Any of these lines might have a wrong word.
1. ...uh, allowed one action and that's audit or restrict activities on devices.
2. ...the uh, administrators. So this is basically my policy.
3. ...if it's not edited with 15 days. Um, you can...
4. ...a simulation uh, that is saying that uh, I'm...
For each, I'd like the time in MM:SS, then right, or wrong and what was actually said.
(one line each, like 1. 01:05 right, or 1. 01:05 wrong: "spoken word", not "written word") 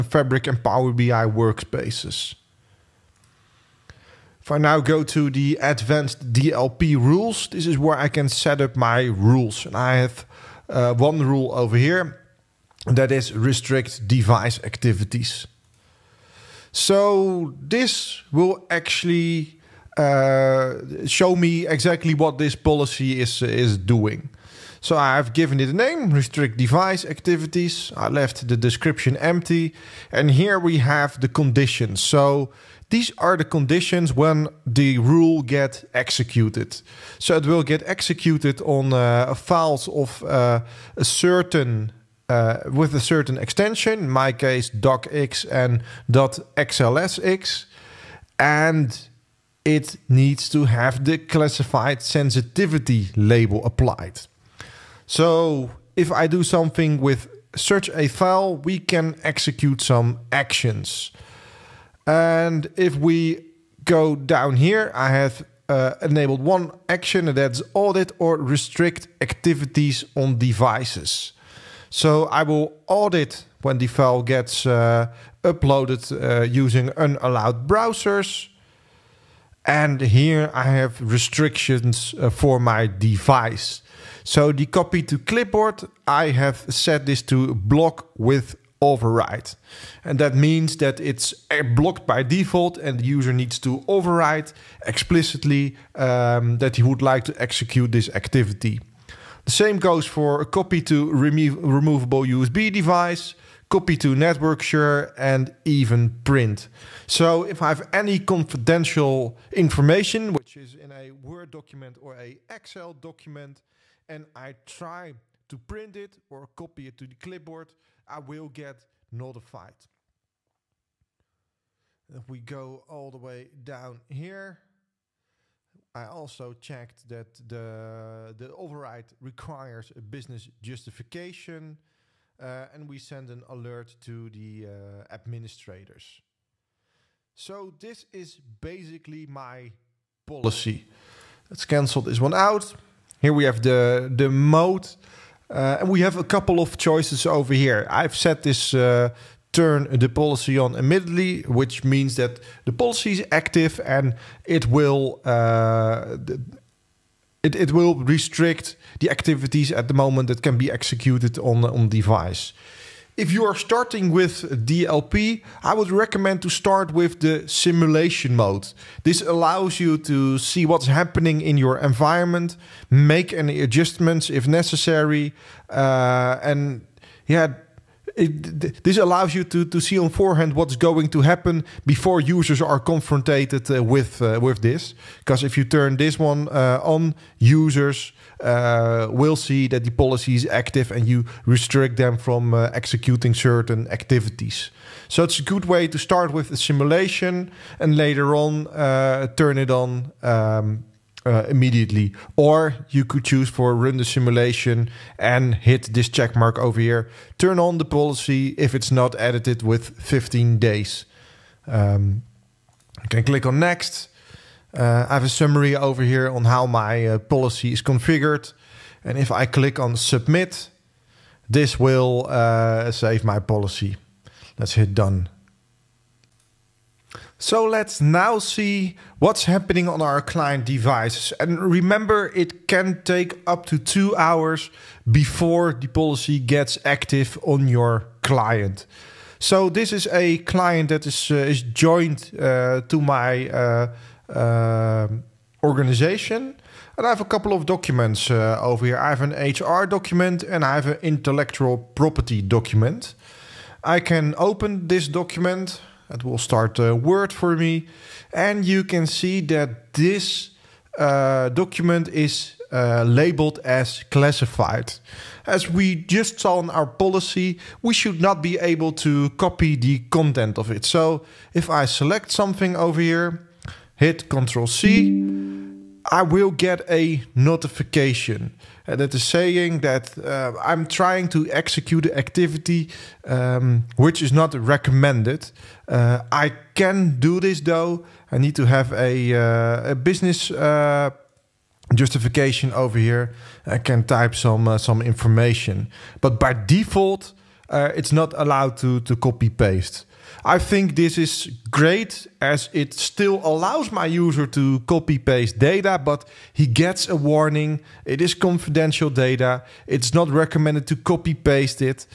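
1. 01:05 wrong: "enabled", not "allowed"
2. 02:14 right
3. 03:28 right
4. 04:36 wrong: "notification", not "simulation".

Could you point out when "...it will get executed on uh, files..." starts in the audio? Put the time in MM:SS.
00:37.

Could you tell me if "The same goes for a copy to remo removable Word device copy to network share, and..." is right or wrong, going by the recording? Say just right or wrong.
wrong.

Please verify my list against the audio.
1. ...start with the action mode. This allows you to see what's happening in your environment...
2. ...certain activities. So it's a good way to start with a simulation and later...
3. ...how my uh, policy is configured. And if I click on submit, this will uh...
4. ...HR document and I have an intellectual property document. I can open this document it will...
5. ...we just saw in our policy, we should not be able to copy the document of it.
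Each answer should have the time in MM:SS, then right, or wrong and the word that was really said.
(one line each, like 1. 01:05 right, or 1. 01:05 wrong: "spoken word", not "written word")
1. 02:46 wrong: "simulation", not "action"
2. 03:13 right
3. 03:36 right
4. 04:09 right
5. 04:25 wrong: "content", not "document".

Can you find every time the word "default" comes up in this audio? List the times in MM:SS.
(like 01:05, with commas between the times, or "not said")
01:32, 04:56.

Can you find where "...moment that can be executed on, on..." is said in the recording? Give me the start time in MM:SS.
02:39.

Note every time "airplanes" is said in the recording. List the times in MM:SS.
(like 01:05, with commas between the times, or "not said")
not said.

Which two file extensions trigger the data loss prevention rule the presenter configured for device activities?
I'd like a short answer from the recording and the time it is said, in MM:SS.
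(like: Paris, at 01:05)
docx and xlsx, at 00:44.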